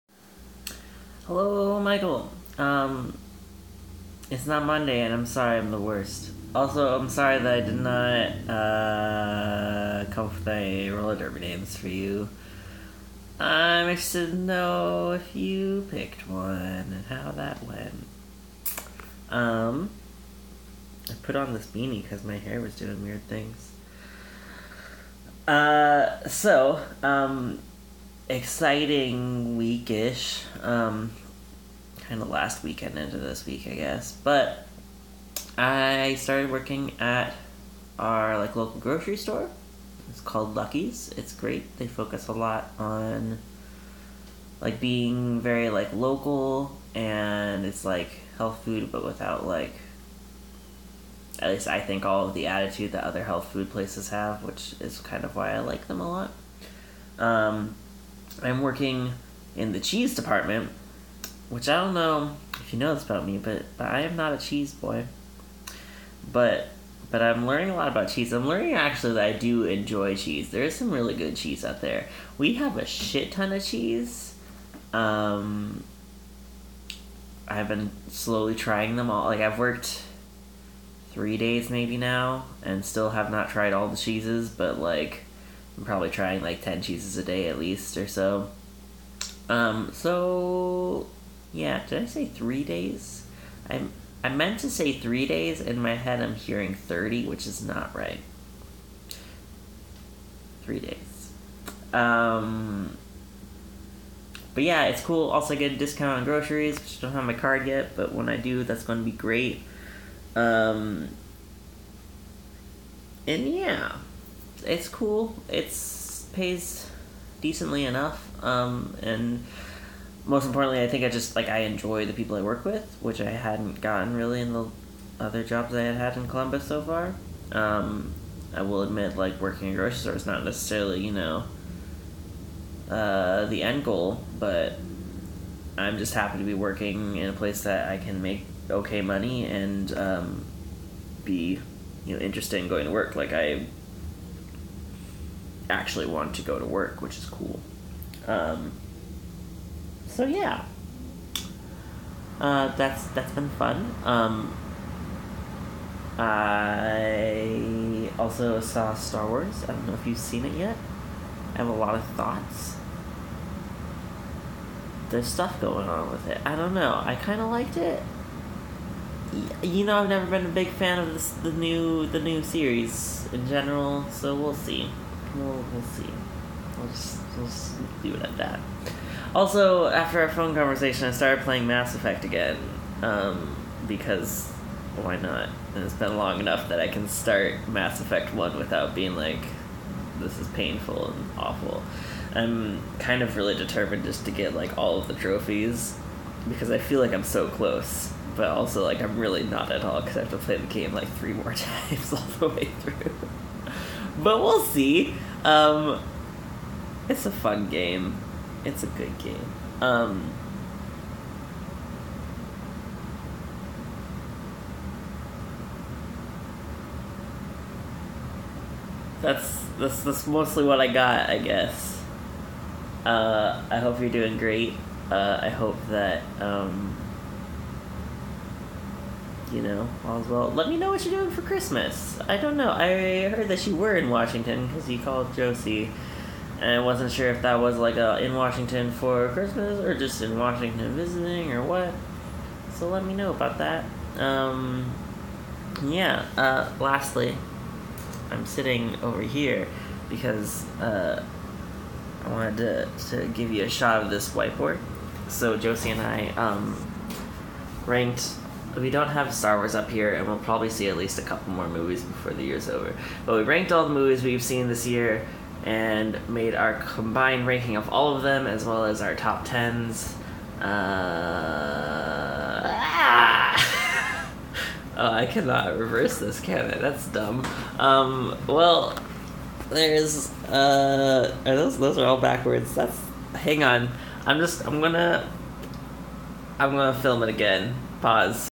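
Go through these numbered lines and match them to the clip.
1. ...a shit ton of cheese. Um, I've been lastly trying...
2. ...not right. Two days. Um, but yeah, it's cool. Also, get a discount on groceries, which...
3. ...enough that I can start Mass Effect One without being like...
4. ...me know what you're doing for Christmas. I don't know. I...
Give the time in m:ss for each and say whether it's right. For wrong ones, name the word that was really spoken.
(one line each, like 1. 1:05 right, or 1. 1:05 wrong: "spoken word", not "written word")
1. 1:12 wrong: "slowly", not "lastly"
2. 1:37 wrong: "Three", not "Two"
3. 3:06 right
4. 3:50 right.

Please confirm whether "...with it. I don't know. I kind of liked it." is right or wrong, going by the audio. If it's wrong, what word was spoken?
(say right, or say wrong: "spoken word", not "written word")
right.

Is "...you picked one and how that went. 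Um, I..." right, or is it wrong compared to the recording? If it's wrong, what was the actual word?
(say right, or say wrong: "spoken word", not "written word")
right.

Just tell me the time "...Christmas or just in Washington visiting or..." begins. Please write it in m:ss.
3:59.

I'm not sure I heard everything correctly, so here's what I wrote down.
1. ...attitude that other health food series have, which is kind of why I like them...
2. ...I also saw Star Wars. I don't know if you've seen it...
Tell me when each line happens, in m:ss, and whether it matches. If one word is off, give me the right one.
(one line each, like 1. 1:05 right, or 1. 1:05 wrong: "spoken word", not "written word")
1. 0:52 wrong: "places", not "series"
2. 2:36 right.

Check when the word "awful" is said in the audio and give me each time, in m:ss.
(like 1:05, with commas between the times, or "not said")
3:11.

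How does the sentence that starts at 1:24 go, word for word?
But like, I'm probably trying like 10 cheeses a day at least or so.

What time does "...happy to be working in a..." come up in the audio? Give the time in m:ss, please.
2:16.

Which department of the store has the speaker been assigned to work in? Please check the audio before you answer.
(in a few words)
Cheese department.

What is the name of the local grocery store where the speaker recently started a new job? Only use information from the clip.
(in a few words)
Lucky's.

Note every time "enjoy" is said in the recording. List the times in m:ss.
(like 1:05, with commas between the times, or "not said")
1:09, 2:01.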